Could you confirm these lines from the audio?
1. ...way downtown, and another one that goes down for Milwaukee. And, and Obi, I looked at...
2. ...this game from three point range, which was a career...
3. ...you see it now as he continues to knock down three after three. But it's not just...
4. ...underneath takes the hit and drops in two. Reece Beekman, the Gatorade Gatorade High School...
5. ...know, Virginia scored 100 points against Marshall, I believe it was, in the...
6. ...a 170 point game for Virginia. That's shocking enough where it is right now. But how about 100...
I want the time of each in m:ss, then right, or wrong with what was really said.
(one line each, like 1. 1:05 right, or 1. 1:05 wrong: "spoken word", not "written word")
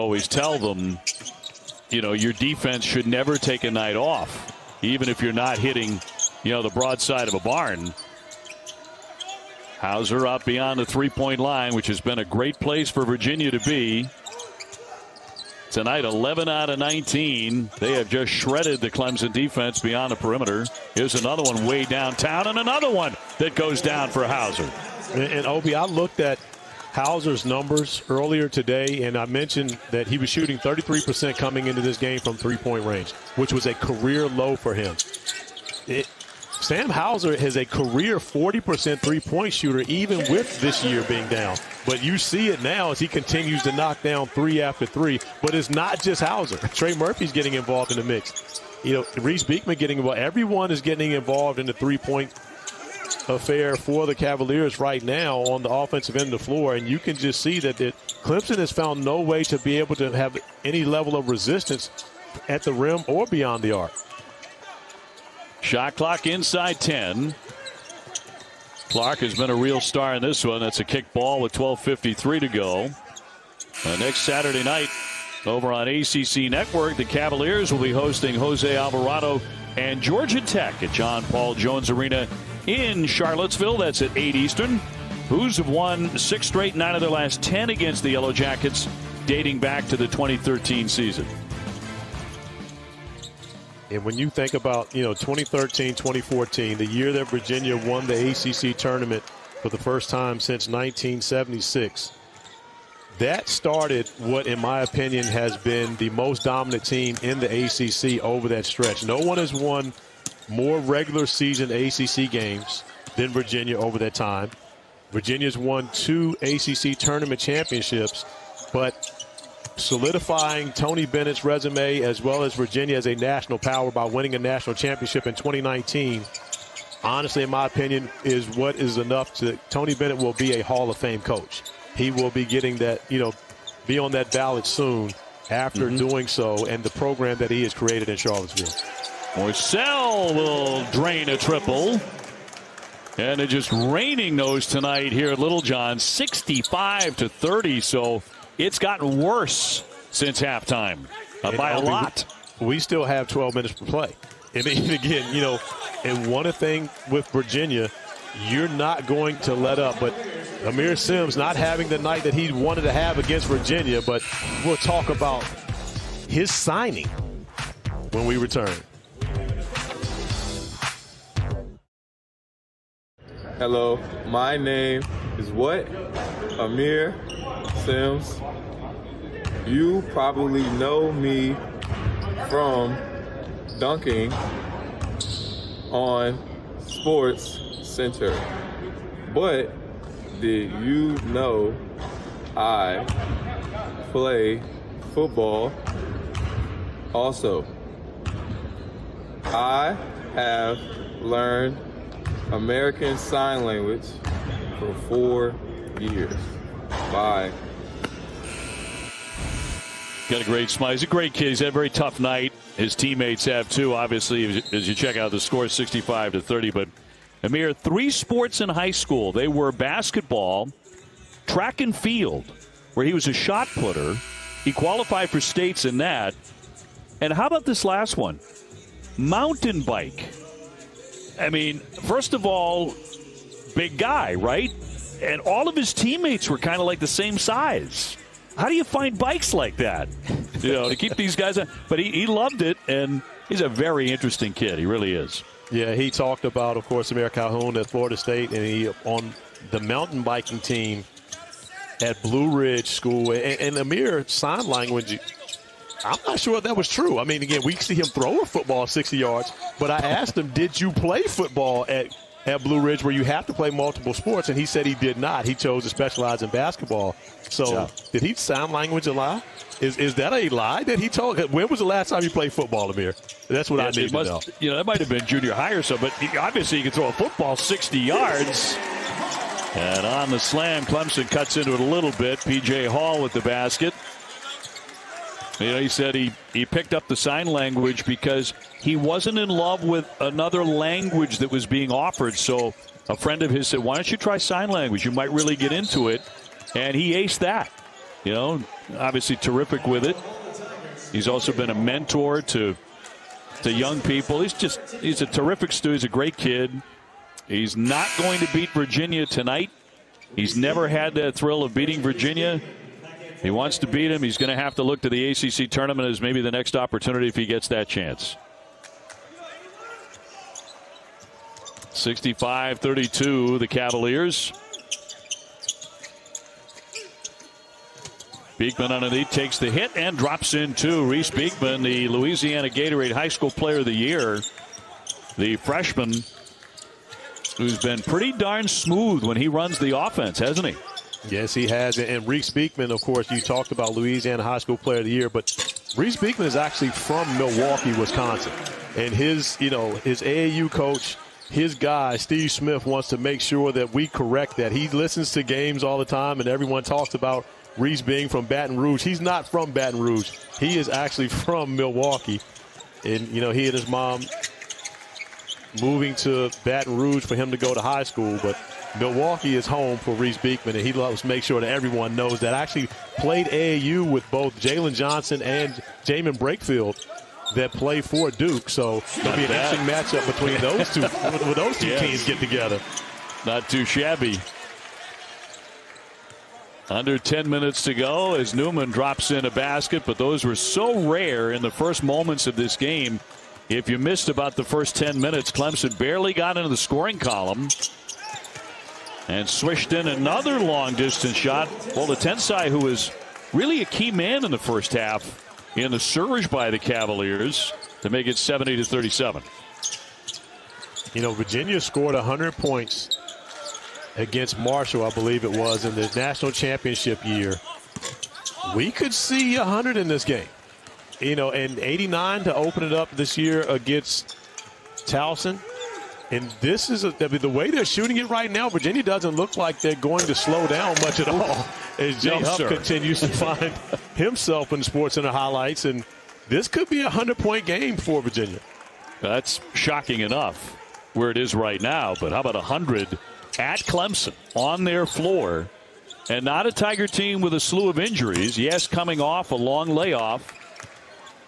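1. 0:21 wrong: "Hauser", not "Milwaukee"
2. 0:31 right
3. 0:42 right
4. 5:28 wrong: "Louisiana", not "Gatorade"
5. 6:51 right
6. 7:17 wrong: "100", not "170".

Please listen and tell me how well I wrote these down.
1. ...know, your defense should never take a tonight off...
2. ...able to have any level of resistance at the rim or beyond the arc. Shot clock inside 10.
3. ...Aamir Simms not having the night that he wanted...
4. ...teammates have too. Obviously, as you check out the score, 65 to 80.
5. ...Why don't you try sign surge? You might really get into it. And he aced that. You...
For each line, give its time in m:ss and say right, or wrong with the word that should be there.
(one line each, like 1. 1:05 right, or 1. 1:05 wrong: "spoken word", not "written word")
1. 0:02 wrong: "night", not "tonight"
2. 0:59 right
3. 2:40 right
4. 3:32 wrong: "30", not "80"
5. 4:53 wrong: "language", not "surge".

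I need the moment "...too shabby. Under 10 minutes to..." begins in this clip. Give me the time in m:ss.
6:23.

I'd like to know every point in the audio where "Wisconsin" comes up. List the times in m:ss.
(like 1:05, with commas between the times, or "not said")
5:47.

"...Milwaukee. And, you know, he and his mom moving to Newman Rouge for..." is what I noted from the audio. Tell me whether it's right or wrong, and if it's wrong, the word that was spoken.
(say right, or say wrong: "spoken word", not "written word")
wrong: "Baton", not "Newman".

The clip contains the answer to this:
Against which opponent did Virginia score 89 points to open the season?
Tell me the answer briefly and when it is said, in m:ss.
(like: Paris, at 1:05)
Towson, at 7:05.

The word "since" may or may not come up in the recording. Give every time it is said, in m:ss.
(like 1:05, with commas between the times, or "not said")
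1:40, 2:30.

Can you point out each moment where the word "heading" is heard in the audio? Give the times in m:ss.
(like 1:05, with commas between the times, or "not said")
not said.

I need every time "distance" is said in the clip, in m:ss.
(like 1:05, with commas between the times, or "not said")
6:40.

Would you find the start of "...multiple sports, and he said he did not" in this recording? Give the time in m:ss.
4:23.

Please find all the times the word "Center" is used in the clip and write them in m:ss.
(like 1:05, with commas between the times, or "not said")
3:07.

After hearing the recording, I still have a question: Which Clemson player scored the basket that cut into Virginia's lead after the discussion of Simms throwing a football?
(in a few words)
P.J. Hall.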